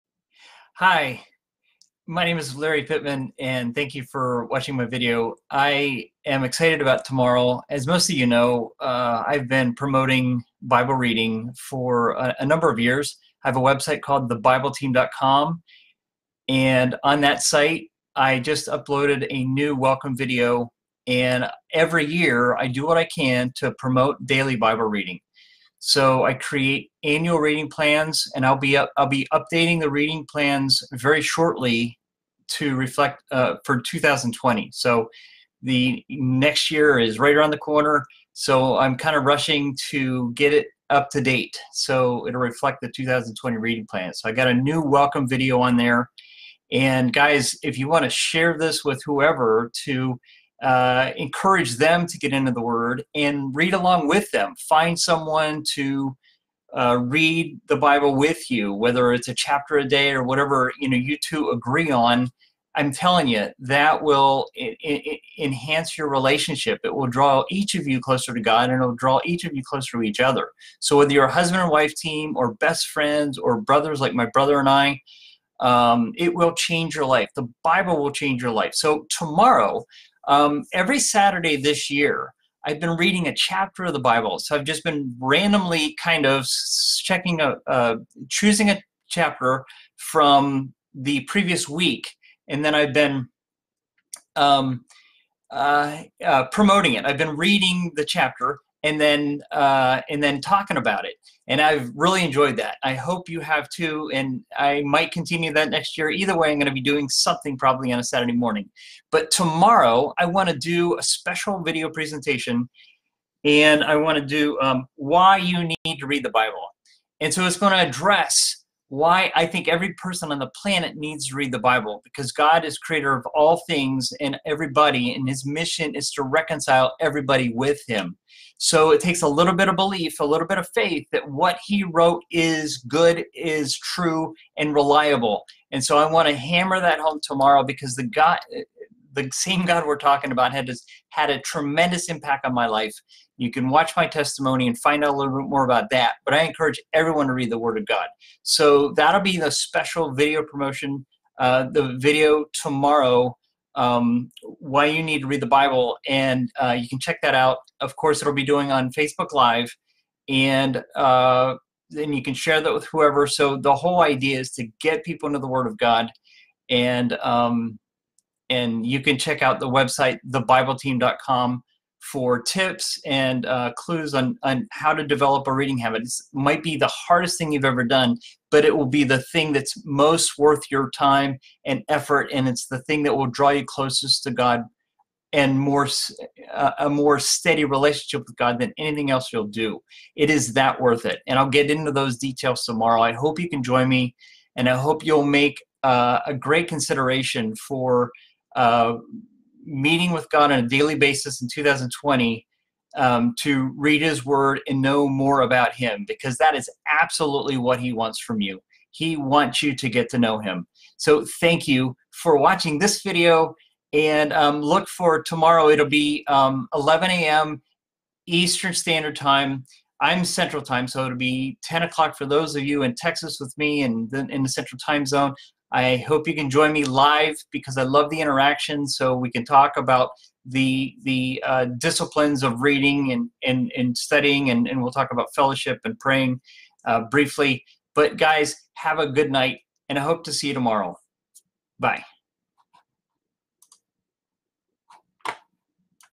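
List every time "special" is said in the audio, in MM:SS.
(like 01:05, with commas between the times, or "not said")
01:51, 02:29.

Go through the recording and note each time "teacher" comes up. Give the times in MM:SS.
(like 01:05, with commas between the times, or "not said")
not said.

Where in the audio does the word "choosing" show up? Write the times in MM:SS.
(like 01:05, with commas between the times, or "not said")
01:28.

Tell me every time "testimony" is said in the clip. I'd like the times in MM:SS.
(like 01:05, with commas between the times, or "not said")
02:24.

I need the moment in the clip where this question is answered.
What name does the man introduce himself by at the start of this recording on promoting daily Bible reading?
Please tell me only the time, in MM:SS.
00:02.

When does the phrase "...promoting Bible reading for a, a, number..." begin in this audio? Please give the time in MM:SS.
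00:09.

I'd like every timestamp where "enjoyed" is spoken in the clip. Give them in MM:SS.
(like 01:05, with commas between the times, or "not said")
01:42.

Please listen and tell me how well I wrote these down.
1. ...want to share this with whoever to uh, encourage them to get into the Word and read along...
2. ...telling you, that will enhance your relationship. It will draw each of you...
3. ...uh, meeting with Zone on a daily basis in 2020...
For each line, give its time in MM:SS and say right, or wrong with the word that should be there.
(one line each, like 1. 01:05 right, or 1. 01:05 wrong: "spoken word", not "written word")
1. 00:47 right
2. 01:02 right
3. 03:18 wrong: "God", not "Zone".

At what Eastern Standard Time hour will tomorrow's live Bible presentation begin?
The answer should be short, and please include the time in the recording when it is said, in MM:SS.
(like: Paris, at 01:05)
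11 a.m., at 03:36.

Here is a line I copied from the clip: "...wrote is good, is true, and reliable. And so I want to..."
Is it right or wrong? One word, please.
right.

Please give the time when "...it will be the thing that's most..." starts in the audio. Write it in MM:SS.
02:58.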